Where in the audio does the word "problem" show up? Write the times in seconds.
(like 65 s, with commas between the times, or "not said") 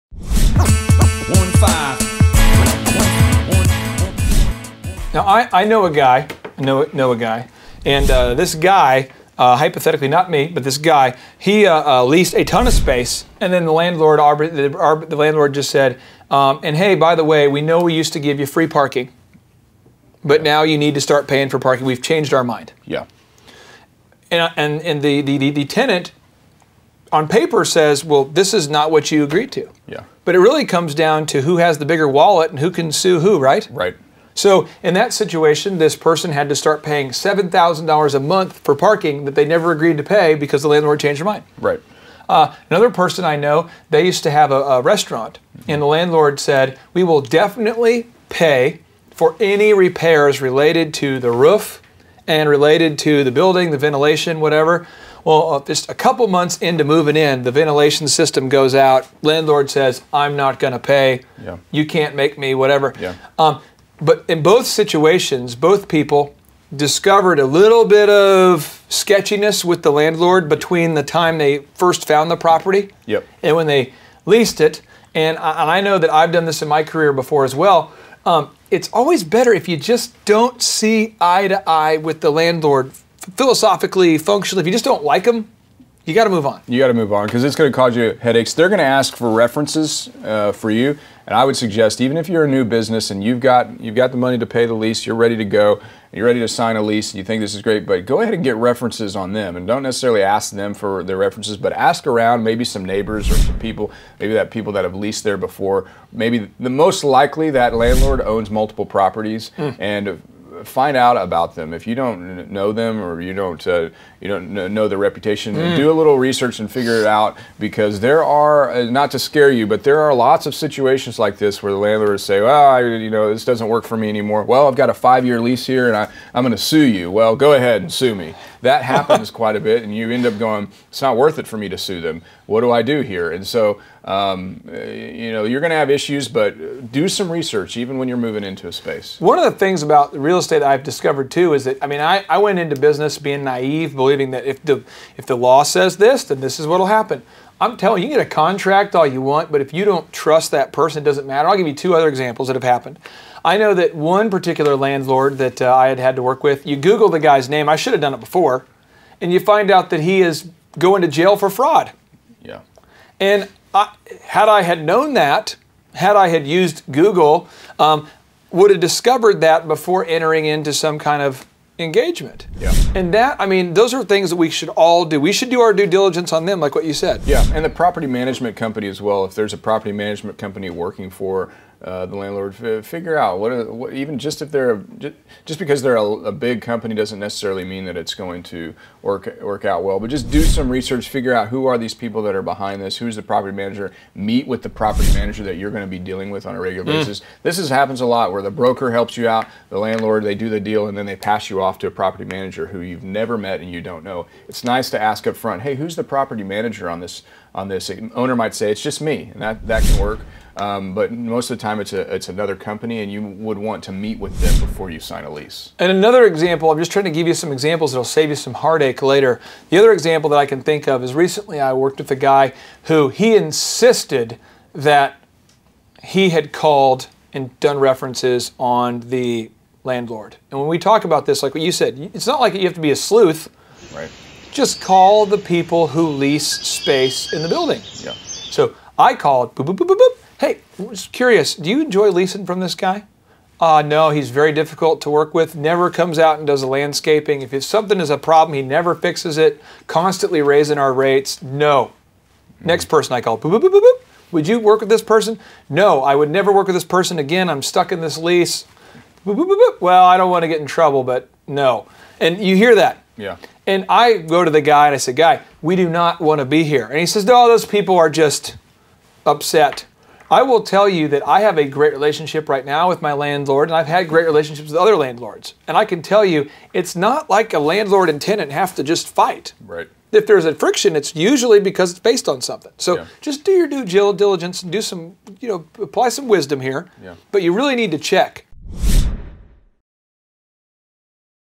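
248 s.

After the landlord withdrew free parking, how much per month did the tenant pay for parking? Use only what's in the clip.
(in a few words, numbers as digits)
$7,000.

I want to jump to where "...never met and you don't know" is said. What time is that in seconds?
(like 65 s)
203 s.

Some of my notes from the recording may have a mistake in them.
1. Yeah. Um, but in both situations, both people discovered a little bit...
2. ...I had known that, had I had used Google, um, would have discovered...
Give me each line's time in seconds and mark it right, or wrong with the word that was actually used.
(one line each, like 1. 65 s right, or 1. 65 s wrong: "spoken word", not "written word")
1. 62 s right
2. 164 s right.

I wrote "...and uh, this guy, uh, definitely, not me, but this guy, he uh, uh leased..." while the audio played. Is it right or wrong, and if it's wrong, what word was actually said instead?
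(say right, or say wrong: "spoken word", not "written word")
wrong: "hypothetically", not "definitely".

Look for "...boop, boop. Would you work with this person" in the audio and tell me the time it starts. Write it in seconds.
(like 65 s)
253 s.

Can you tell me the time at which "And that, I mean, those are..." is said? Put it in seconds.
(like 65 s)
172 s.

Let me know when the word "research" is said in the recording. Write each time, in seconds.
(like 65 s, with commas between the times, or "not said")
116 s, 137 s, 190 s.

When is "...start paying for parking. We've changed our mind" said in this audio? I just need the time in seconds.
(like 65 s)
21 s.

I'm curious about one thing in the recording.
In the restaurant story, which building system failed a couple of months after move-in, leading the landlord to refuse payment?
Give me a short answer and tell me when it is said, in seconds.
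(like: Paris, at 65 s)
ventilation system, at 57 s.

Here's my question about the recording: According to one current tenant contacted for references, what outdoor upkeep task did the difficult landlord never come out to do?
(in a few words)
landscaping.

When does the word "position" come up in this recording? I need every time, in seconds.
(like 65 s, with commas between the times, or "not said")
not said.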